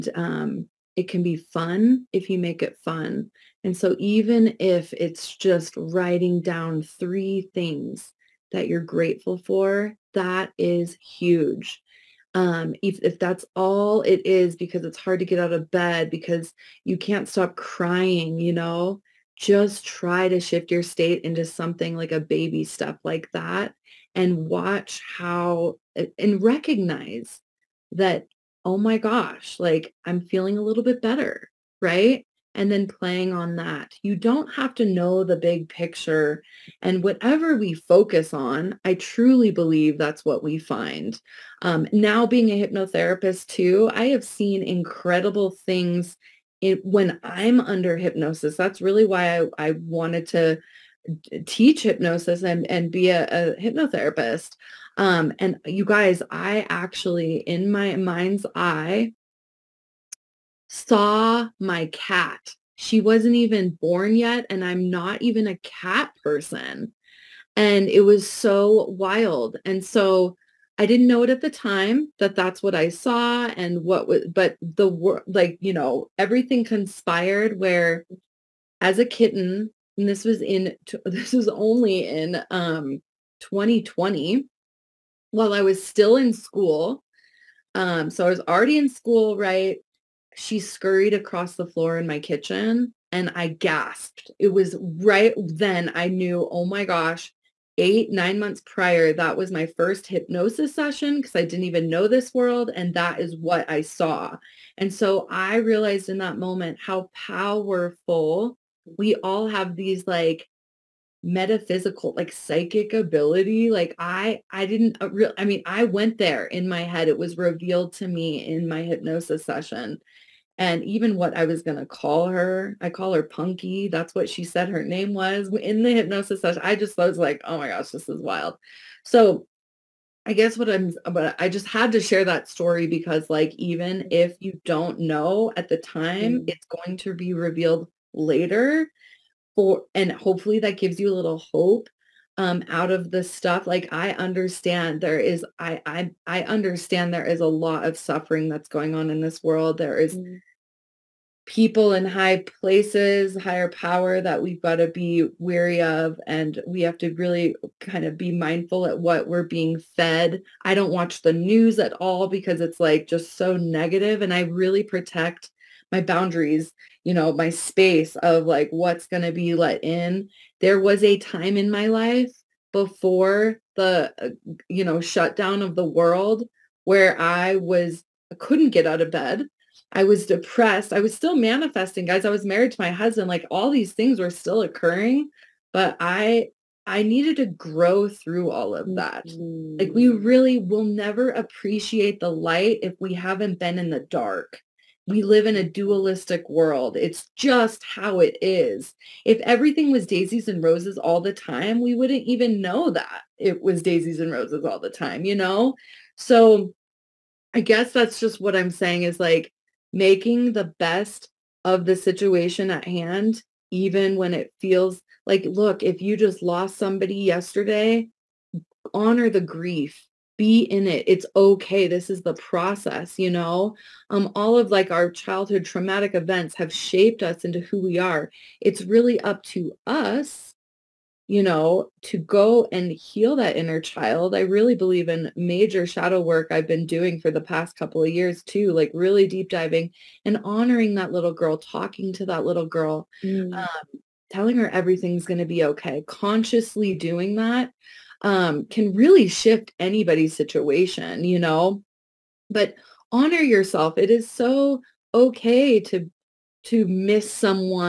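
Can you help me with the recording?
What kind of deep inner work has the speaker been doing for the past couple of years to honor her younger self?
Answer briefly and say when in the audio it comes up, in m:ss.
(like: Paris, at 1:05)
Shadow work, at 3:55.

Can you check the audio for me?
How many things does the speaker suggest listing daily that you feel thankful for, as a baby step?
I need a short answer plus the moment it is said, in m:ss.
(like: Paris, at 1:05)
3, at 0:06.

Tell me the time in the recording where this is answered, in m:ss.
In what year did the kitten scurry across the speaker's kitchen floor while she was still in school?
1:23.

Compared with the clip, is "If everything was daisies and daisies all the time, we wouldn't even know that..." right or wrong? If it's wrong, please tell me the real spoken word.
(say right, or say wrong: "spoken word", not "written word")
wrong: "roses", not "daisies".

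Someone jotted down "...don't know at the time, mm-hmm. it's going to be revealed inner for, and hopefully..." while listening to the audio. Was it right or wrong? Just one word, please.
wrong.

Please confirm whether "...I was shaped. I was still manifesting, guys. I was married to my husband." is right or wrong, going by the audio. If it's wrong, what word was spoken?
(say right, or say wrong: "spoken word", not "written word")
wrong: "depressed", not "shaped".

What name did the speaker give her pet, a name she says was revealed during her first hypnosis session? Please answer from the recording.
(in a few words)
Punky.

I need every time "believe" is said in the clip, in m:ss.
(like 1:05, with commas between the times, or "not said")
0:39, 3:54.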